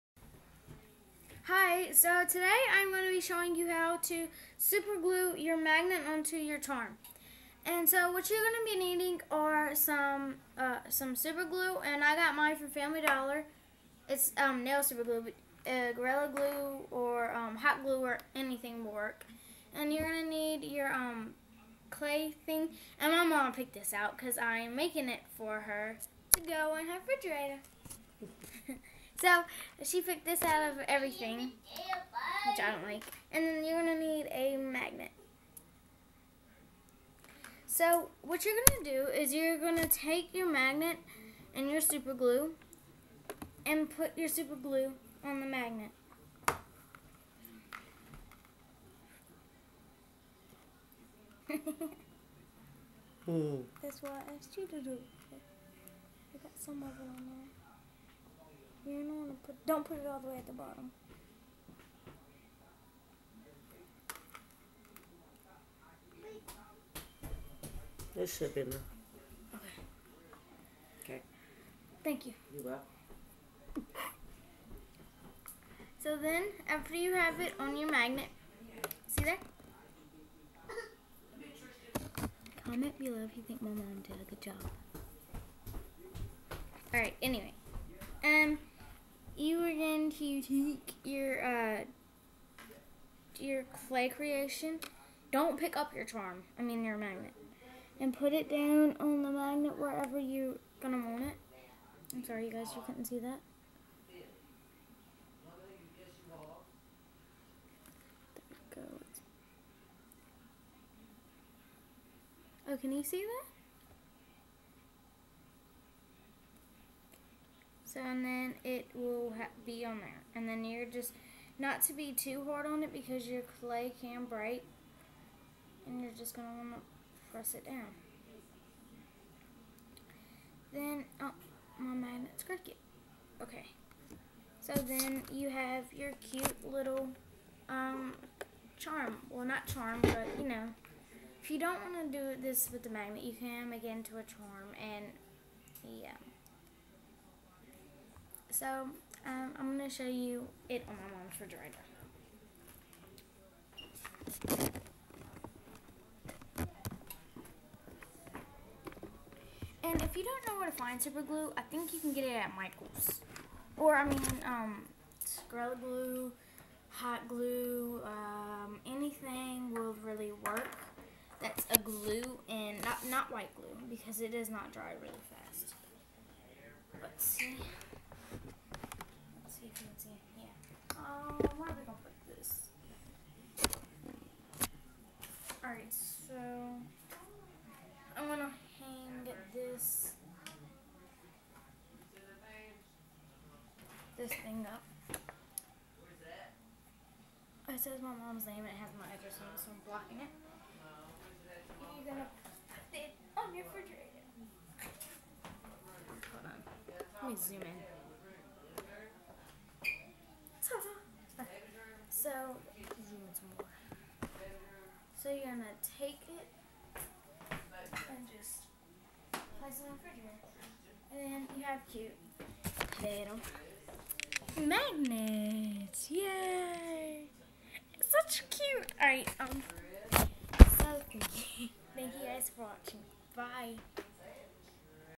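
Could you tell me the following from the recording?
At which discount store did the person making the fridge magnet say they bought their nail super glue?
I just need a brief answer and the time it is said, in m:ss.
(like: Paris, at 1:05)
Family Dollar, at 0:12.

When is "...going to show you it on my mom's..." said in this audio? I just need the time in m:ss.
2:29.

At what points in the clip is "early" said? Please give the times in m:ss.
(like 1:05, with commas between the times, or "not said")
not said.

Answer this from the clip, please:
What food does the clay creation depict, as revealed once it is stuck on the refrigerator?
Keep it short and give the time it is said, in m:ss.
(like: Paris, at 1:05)
Potato, at 3:42.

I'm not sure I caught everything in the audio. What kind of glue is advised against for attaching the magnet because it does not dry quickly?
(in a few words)
White glue.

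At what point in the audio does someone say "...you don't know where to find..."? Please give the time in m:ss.
2:40.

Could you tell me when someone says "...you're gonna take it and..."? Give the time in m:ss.
3:35.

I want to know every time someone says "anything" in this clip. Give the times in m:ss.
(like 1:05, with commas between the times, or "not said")
0:18, 2:48.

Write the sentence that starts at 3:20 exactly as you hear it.
you're gonna put it on your refrigerator.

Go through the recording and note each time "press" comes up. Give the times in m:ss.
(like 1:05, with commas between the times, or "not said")
2:07.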